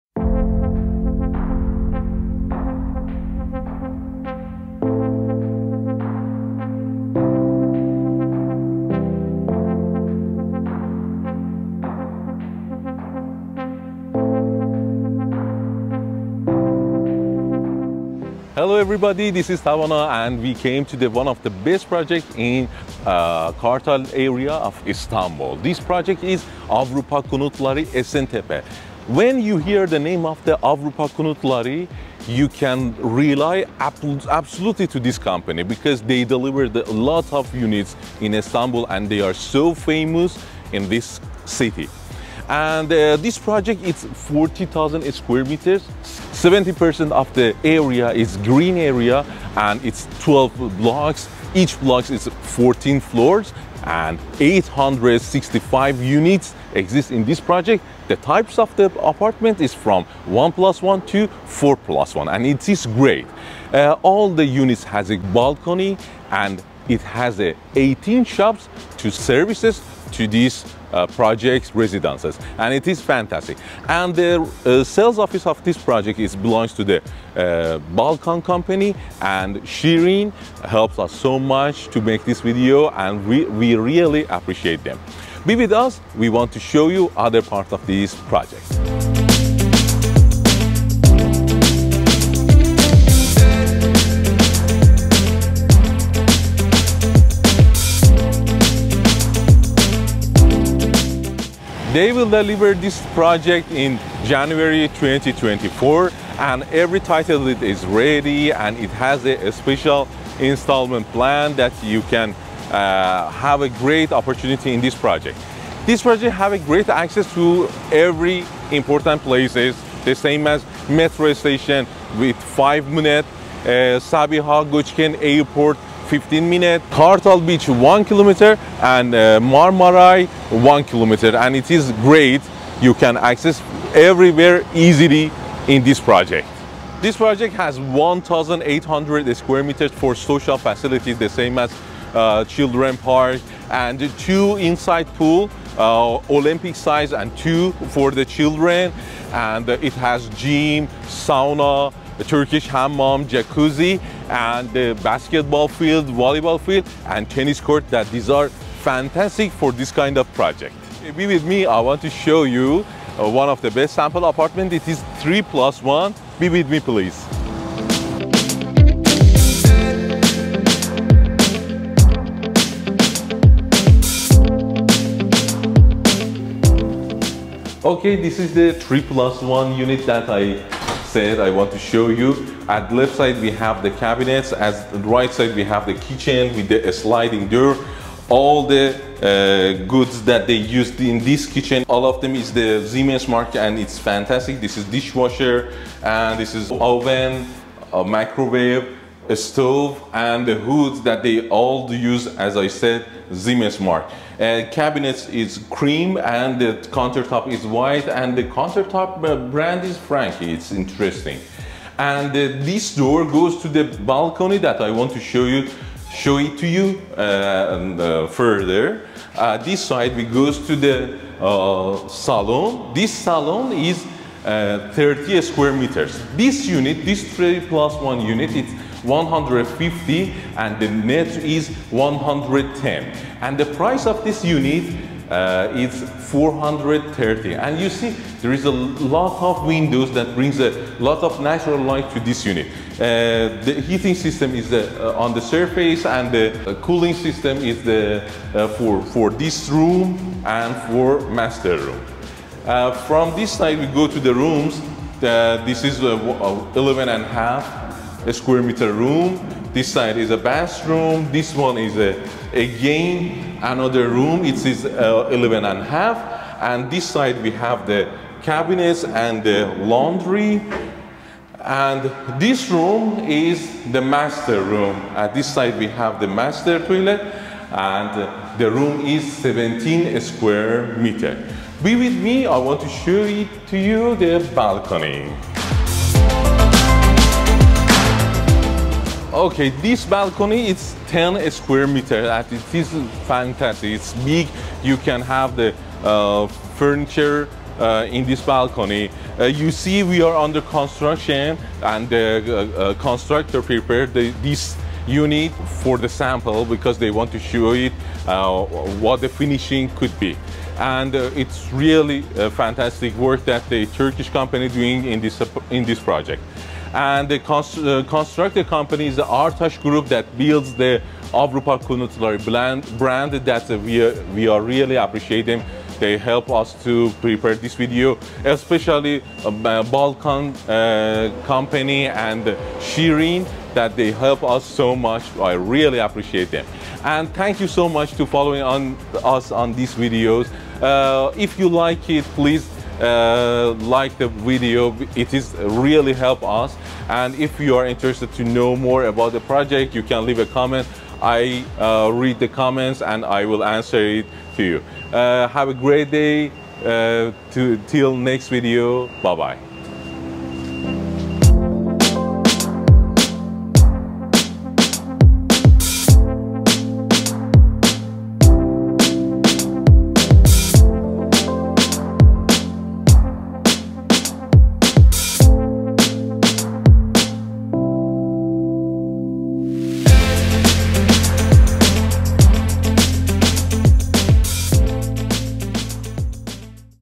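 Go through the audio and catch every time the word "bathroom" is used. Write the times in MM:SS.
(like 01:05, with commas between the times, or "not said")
04:20.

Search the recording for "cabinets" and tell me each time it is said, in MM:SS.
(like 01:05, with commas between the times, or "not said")
03:04, 03:24, 04:28.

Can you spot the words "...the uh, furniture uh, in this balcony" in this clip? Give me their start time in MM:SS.
04:55.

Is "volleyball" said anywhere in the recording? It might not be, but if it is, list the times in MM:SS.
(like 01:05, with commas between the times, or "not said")
02:36.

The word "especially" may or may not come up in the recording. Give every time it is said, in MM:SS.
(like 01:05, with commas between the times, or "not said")
05:28.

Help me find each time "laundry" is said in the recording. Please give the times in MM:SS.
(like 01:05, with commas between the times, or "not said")
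04:29.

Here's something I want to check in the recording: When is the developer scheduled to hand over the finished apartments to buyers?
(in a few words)
January 2024.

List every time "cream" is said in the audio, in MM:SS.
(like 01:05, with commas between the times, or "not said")
03:25.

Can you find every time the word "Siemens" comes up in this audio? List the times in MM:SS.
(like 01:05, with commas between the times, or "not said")
03:12, 03:23.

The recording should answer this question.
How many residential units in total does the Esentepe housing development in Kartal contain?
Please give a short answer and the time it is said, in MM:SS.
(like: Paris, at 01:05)
865, at 00:54.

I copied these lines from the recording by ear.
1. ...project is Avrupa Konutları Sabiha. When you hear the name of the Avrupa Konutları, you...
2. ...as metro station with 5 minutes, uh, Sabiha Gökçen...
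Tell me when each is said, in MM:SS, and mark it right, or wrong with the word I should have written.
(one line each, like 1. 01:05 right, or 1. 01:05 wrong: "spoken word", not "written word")
1. 00:25 wrong: "Esentepe", not "Sabiha"
2. 02:00 right.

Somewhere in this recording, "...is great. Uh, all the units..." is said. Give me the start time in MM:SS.
01:02.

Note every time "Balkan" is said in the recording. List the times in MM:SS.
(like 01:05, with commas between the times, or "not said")
01:17, 05:29.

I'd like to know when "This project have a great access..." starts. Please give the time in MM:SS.
01:55.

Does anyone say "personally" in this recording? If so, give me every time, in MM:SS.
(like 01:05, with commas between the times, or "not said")
not said.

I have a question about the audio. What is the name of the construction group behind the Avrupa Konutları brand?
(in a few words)
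Artaş Group.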